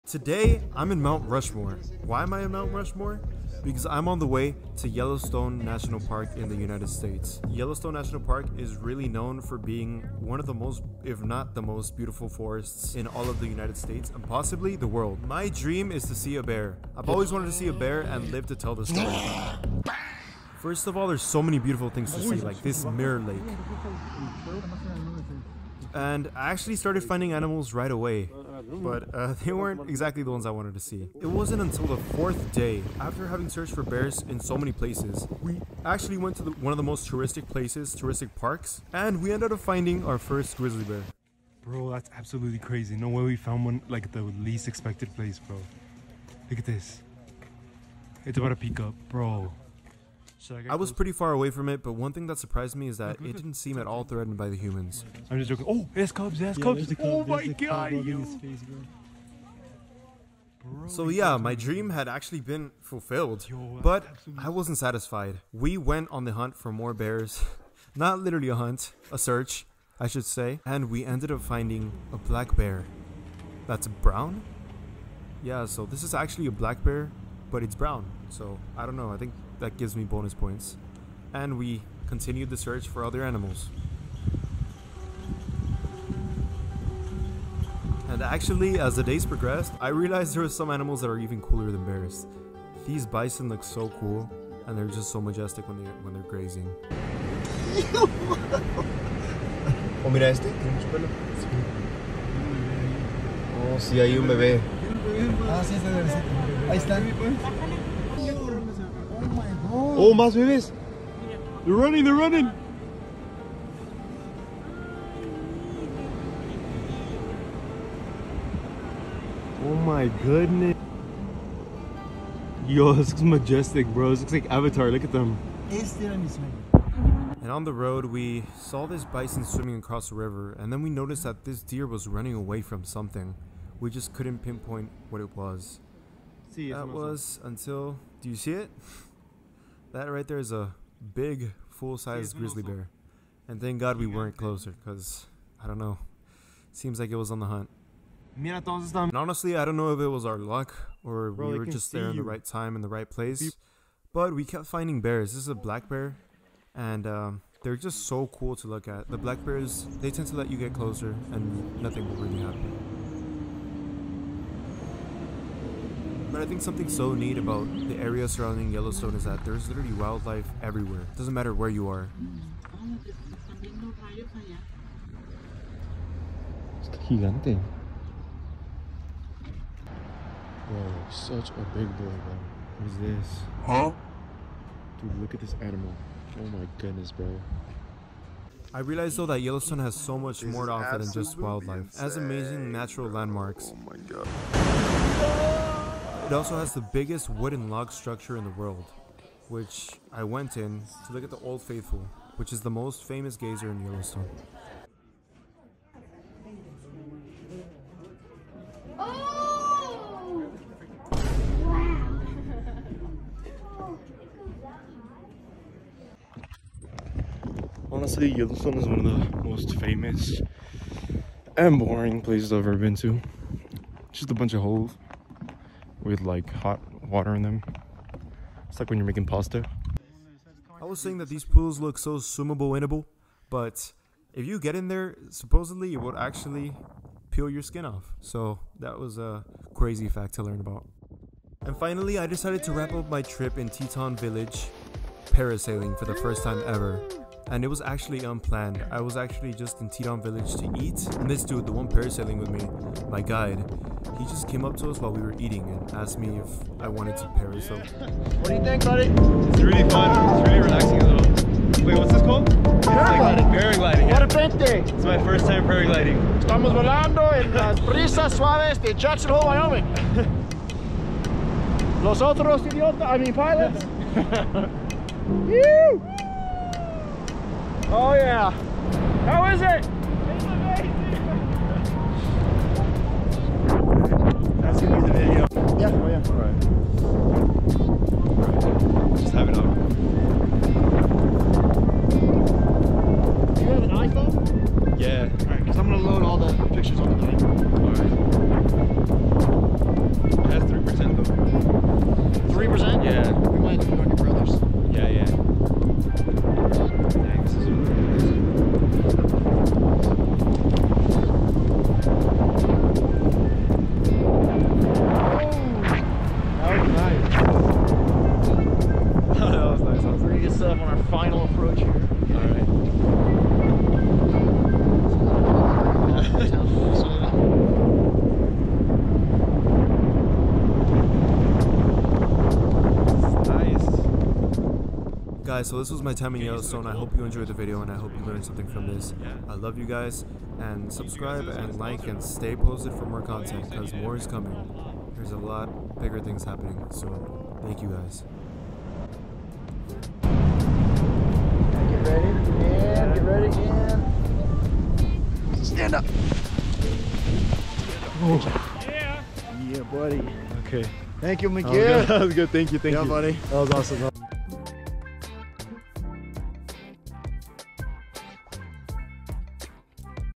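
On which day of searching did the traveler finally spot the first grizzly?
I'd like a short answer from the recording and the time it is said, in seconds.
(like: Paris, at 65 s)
fourth day, at 32 s.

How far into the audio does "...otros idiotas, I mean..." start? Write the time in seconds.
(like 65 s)
272 s.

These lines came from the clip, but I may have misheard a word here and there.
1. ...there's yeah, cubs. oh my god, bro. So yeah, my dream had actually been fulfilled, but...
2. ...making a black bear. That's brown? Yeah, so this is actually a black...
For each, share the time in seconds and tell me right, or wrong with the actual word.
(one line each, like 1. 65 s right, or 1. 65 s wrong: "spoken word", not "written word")
1. 56 s right
2. 71 s wrong: "finding", not "making".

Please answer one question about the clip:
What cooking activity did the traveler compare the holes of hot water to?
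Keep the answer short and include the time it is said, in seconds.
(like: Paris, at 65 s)
making pasta, at 229 s.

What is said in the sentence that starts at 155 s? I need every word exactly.
This is a black bear, and um, they're just so cool to look at.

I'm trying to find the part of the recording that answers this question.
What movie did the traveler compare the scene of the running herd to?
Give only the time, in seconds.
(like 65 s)
124 s.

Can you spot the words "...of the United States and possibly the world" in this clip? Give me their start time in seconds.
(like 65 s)
13 s.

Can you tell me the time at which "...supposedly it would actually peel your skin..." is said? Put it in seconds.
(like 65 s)
235 s.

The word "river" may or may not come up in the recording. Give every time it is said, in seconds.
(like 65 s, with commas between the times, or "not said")
130 s.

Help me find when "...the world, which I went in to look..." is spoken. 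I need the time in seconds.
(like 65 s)
198 s.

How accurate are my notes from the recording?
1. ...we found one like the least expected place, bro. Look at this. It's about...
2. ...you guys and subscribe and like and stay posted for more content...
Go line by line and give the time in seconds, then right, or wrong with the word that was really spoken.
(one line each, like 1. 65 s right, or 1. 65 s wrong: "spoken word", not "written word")
1. 43 s right
2. 339 s right.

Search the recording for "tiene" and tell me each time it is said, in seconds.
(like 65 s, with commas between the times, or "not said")
100 s.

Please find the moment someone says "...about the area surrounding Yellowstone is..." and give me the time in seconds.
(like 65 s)
167 s.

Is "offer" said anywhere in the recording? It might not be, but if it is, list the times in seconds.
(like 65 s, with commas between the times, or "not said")
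190 s.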